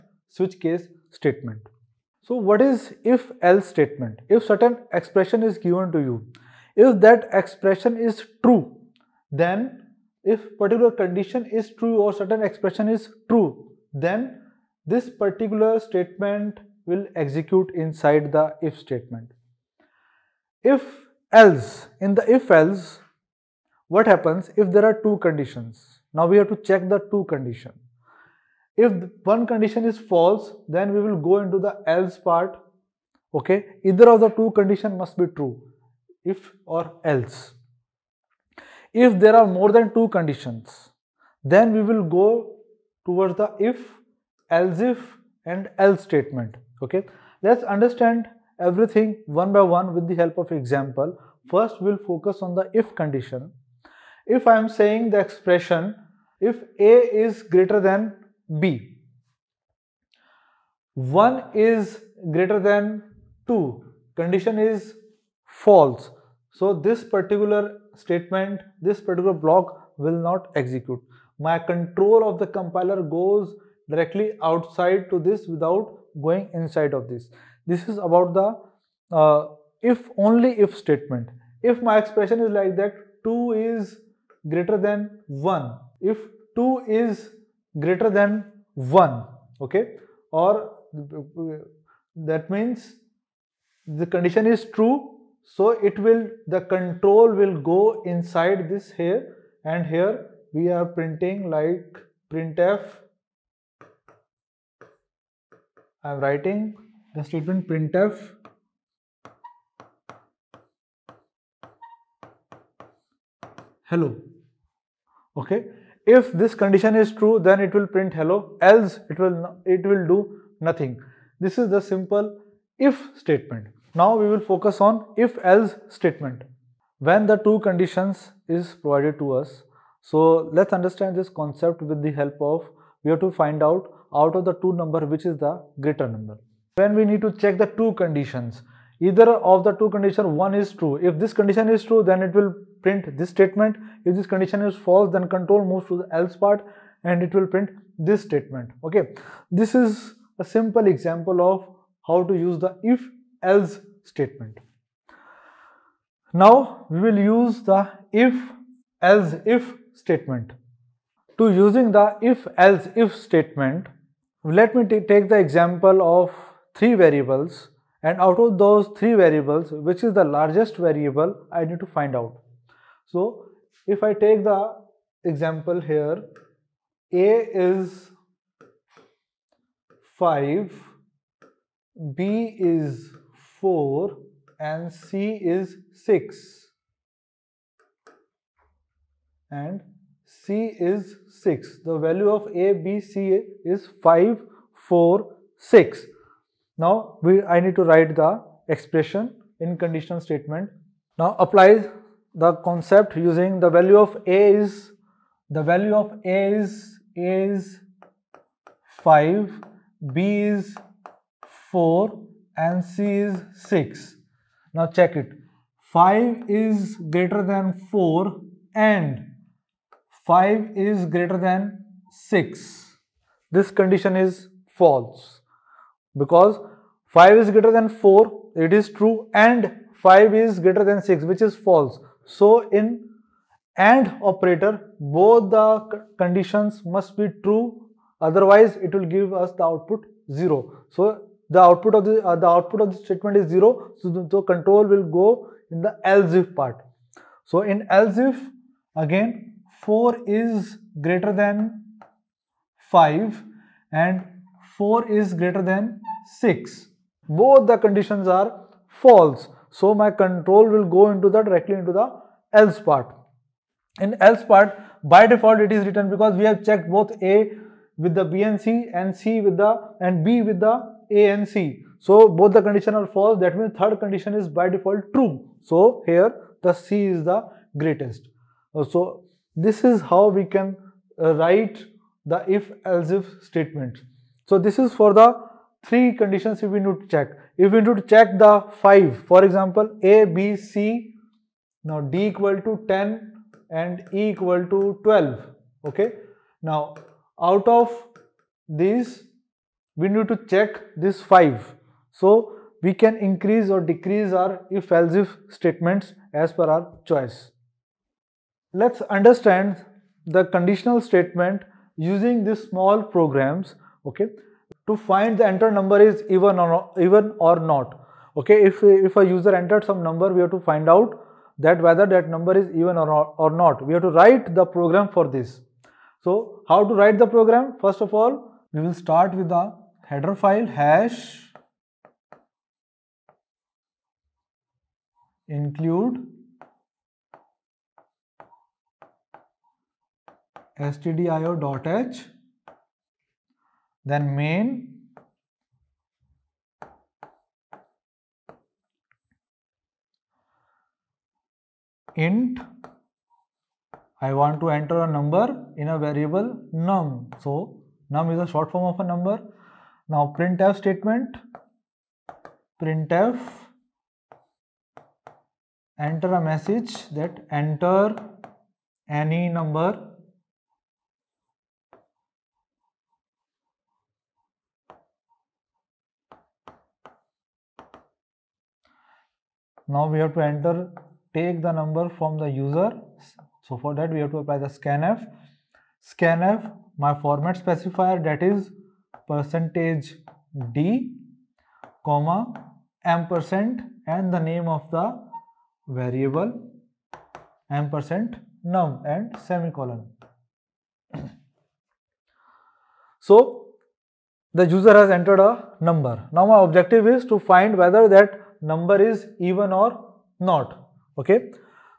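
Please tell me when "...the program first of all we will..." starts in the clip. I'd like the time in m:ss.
5:27.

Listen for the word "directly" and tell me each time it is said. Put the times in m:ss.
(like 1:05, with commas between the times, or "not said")
1:13, 4:21.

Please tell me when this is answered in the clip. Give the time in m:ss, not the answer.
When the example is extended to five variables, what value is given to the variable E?
4:54.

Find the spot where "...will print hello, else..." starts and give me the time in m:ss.
1:57.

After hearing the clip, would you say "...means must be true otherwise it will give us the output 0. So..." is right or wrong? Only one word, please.
wrong.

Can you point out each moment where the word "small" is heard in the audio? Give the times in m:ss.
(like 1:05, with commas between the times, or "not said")
5:12.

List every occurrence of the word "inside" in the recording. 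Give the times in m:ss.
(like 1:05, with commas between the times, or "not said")
0:17, 1:16, 1:38.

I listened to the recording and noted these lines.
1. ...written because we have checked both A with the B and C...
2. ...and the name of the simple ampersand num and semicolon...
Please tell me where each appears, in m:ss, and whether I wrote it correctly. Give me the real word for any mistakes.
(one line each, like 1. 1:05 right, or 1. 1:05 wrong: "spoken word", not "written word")
1. 4:25 right
2. 6:34 wrong: "variable", not "simple".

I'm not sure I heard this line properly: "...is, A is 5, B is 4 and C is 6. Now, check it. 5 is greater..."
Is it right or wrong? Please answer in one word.
right.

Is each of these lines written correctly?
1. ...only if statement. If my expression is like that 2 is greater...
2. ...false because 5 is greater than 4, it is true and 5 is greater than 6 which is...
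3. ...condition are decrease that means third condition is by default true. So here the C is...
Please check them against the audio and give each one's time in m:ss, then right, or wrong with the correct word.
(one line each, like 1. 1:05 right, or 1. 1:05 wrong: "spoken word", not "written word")
1. 1:20 right
2. 3:44 right
3. 4:32 wrong: "false", not "decrease".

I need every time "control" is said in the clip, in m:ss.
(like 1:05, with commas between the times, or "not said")
1:11, 1:36, 2:25, 4:04, 4:20.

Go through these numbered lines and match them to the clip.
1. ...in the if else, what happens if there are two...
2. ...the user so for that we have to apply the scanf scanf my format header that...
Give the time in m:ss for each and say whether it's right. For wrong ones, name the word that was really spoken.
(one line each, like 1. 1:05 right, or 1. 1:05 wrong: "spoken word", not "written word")
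1. 0:21 right
2. 6:22 wrong: "specifier", not "header".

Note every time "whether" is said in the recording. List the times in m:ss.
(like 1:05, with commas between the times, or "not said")
5:21, 6:47.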